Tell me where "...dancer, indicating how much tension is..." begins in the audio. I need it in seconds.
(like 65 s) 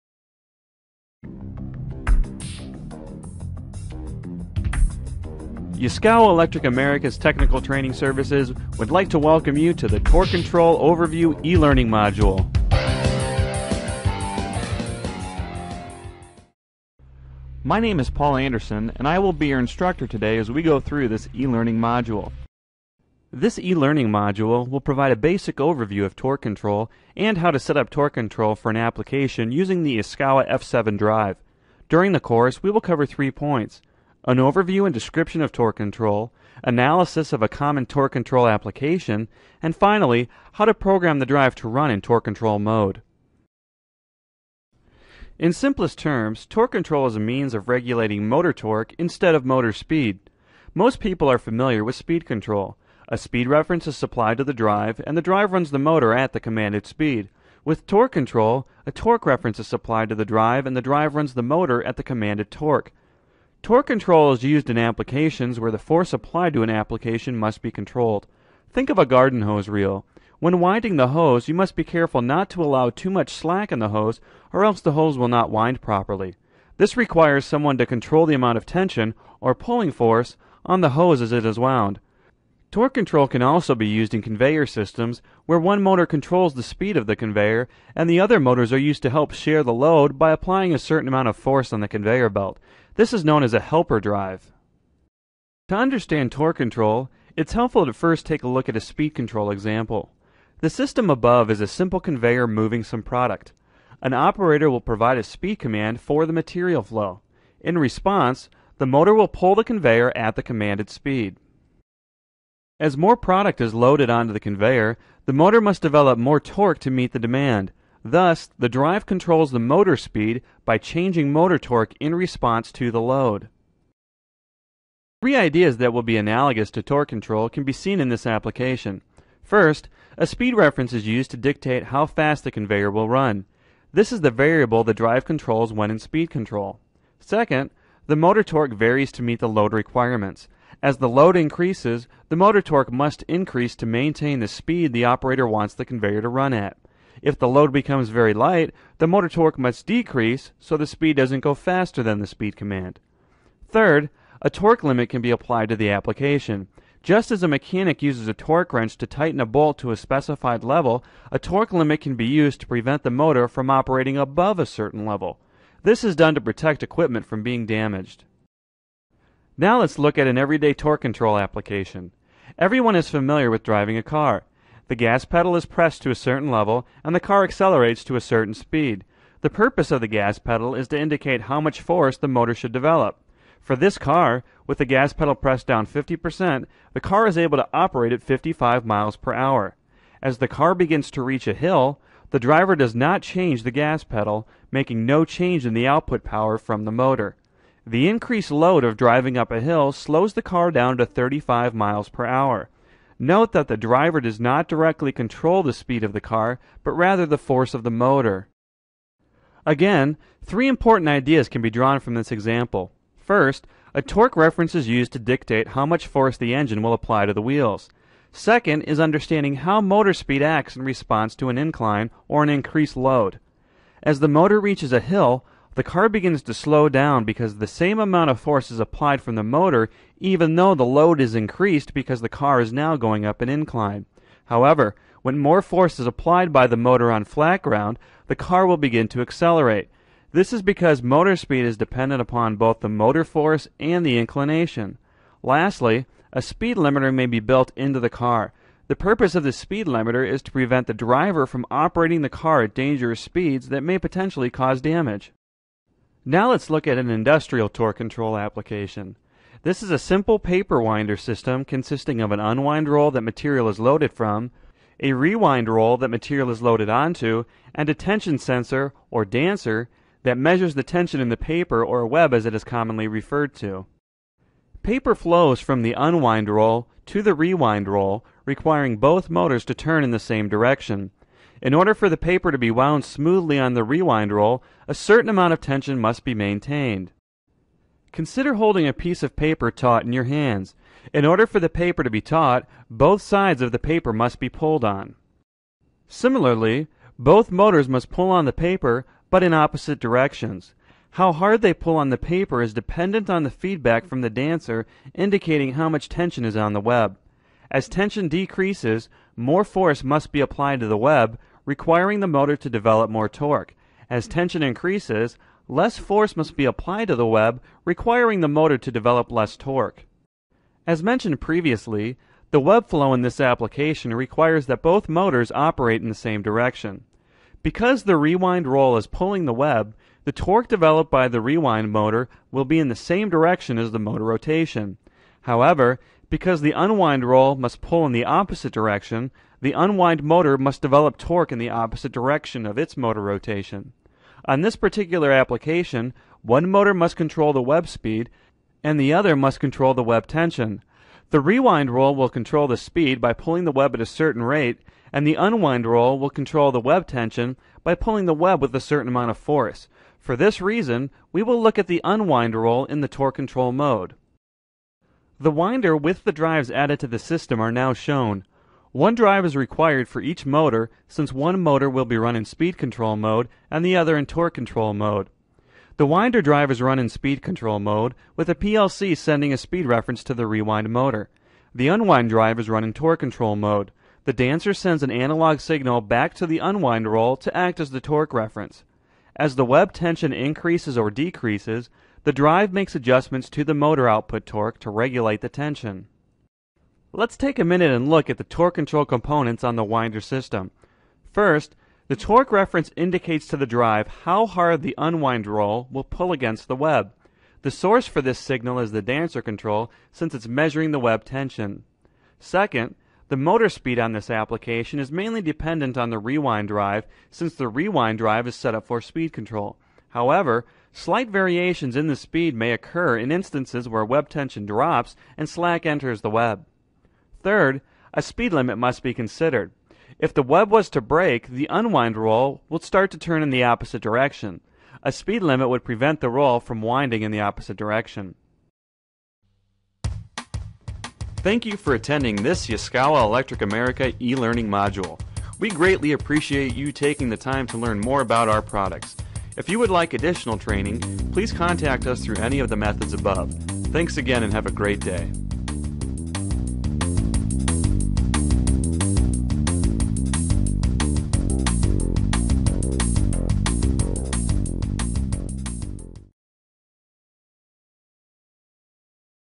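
304 s.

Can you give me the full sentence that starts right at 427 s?
Third, a speed limit must be considered.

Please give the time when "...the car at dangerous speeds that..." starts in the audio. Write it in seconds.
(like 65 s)
252 s.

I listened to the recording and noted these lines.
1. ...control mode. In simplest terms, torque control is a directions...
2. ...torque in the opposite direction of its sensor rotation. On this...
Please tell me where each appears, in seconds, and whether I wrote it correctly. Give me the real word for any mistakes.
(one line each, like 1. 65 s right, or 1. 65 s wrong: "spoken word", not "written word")
1. 42 s wrong: "means", not "directions"
2. 341 s wrong: "motor", not "sensor".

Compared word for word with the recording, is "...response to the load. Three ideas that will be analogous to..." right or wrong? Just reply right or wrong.
right.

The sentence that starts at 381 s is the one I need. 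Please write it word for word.
The unwind drive is run in torque control mode.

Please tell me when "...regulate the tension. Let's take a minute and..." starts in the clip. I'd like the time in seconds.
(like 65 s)
394 s.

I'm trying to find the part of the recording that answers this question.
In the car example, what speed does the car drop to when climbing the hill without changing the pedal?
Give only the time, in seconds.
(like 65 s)
201 s.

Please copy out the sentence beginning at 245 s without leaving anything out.
Lastly, a speed limiter may be built into the car.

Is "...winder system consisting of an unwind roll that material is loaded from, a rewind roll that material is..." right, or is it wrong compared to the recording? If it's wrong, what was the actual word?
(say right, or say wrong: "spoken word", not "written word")
right.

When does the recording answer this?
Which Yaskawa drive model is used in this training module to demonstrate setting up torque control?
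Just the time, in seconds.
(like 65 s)
30 s.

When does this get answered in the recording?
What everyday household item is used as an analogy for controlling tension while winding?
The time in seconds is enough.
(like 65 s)
69 s.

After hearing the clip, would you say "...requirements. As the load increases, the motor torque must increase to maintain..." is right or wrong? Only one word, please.
right.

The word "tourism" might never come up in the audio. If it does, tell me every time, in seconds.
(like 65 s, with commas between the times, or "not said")
not said.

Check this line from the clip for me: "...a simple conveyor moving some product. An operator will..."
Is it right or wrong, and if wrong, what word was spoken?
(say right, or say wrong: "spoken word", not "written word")
right.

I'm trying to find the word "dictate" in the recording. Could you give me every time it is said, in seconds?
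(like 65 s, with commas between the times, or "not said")
131 s, 215 s.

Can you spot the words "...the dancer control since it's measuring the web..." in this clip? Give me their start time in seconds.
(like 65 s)
408 s.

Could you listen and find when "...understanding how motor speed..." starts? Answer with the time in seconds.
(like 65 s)
218 s.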